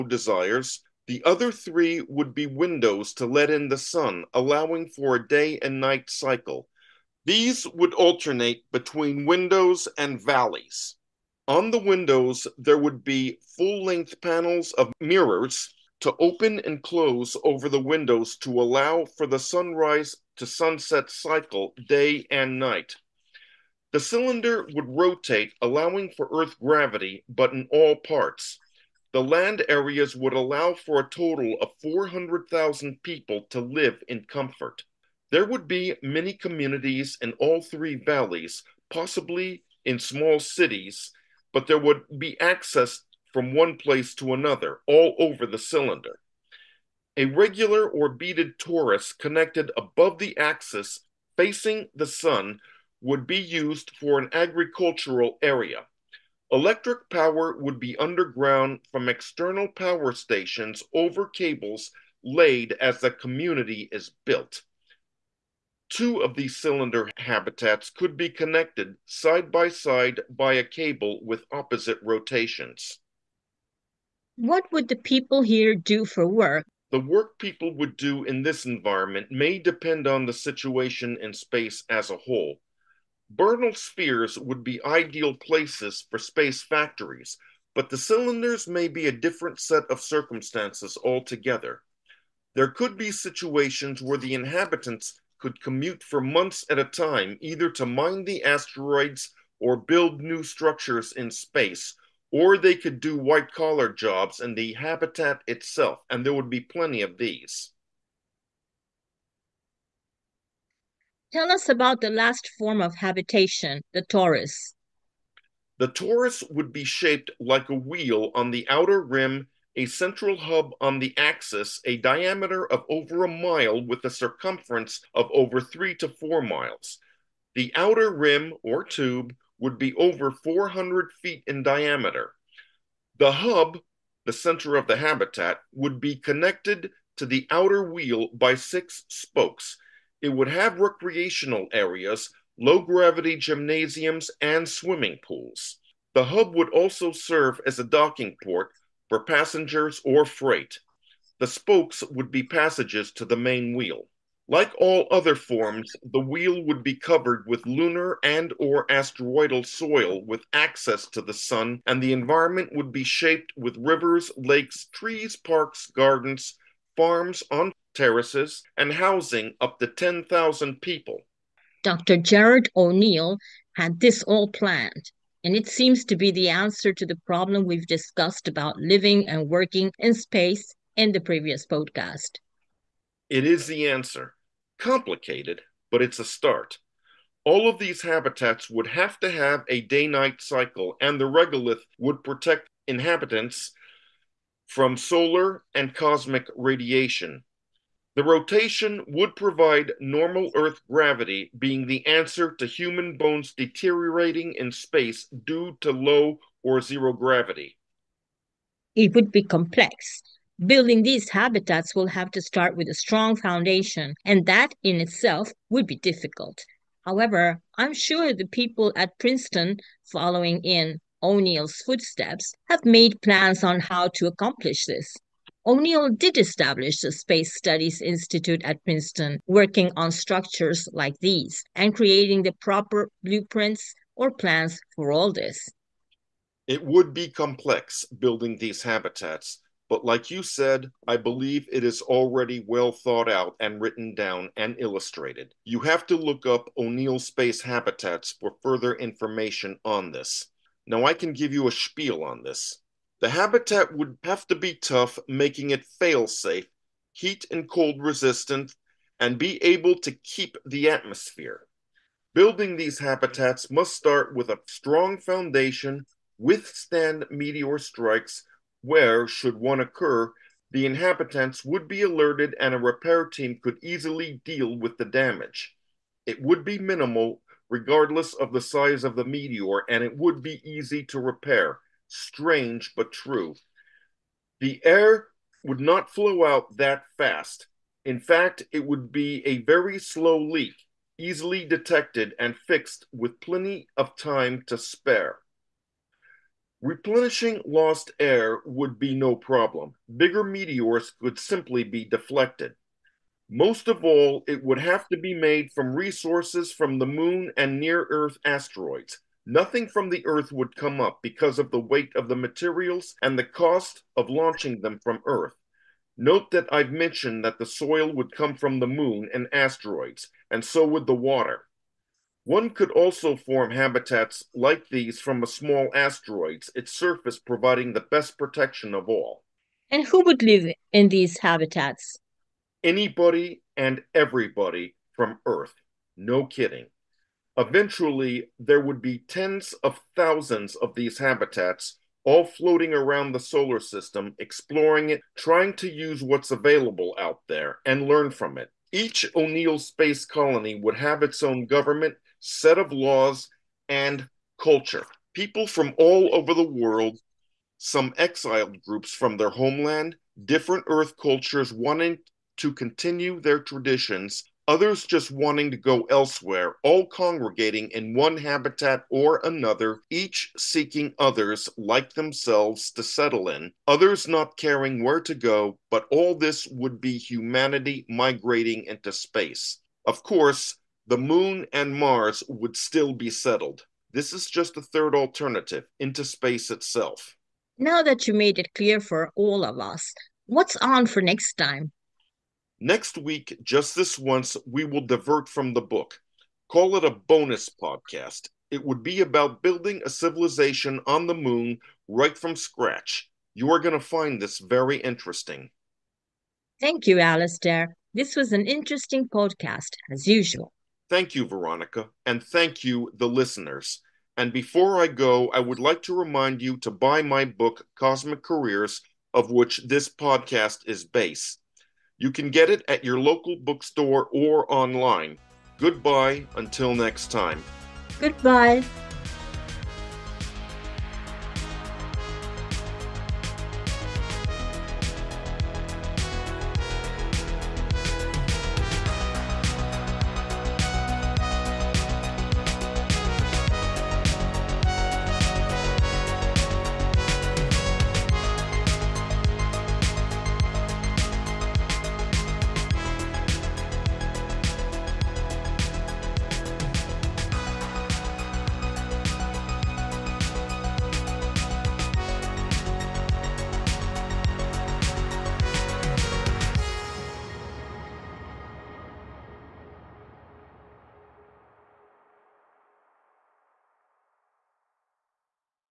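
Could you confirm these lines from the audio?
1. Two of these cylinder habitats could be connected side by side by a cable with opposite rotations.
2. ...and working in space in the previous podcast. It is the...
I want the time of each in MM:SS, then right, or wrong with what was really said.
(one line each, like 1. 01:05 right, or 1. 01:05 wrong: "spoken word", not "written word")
1. 01:05 right
2. 02:59 right.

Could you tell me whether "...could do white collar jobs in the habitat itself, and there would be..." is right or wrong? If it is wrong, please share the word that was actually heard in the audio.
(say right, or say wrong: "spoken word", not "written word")
right.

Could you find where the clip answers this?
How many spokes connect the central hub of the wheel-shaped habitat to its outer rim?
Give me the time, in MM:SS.
02:18.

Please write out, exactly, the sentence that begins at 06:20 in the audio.
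Of course, the moon and Mars would still be settled.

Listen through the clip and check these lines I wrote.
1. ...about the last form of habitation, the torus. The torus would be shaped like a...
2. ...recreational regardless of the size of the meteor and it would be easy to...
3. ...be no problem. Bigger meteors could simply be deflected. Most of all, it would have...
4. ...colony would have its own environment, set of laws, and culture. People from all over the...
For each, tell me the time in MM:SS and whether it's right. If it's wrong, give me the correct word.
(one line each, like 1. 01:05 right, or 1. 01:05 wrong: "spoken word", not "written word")
1. 01:51 right
2. 04:36 wrong: "minimal", not "recreational"
3. 04:58 right
4. 05:50 wrong: "government", not "environment".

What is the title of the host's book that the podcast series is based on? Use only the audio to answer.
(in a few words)
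Cosmic Careers.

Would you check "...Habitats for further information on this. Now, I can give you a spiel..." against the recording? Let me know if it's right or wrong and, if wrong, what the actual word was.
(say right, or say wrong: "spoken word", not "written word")
right.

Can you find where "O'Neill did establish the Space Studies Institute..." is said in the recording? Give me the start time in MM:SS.
03:45.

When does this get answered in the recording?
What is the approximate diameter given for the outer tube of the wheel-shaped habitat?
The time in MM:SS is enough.
02:10.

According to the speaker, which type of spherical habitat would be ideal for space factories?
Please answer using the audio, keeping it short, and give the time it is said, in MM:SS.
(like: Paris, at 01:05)
Bernal spheres, at 01:23.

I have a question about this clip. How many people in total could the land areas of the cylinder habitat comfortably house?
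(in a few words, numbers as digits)
400,000.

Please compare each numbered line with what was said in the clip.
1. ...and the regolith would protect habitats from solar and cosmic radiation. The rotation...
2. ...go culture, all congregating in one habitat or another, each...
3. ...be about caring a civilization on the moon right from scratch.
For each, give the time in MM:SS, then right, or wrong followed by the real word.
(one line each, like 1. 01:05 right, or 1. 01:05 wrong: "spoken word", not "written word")
1. 03:10 wrong: "inhabitants", not "habitats"
2. 06:05 wrong: "elsewhere", not "culture"
3. 06:39 wrong: "building", not "caring".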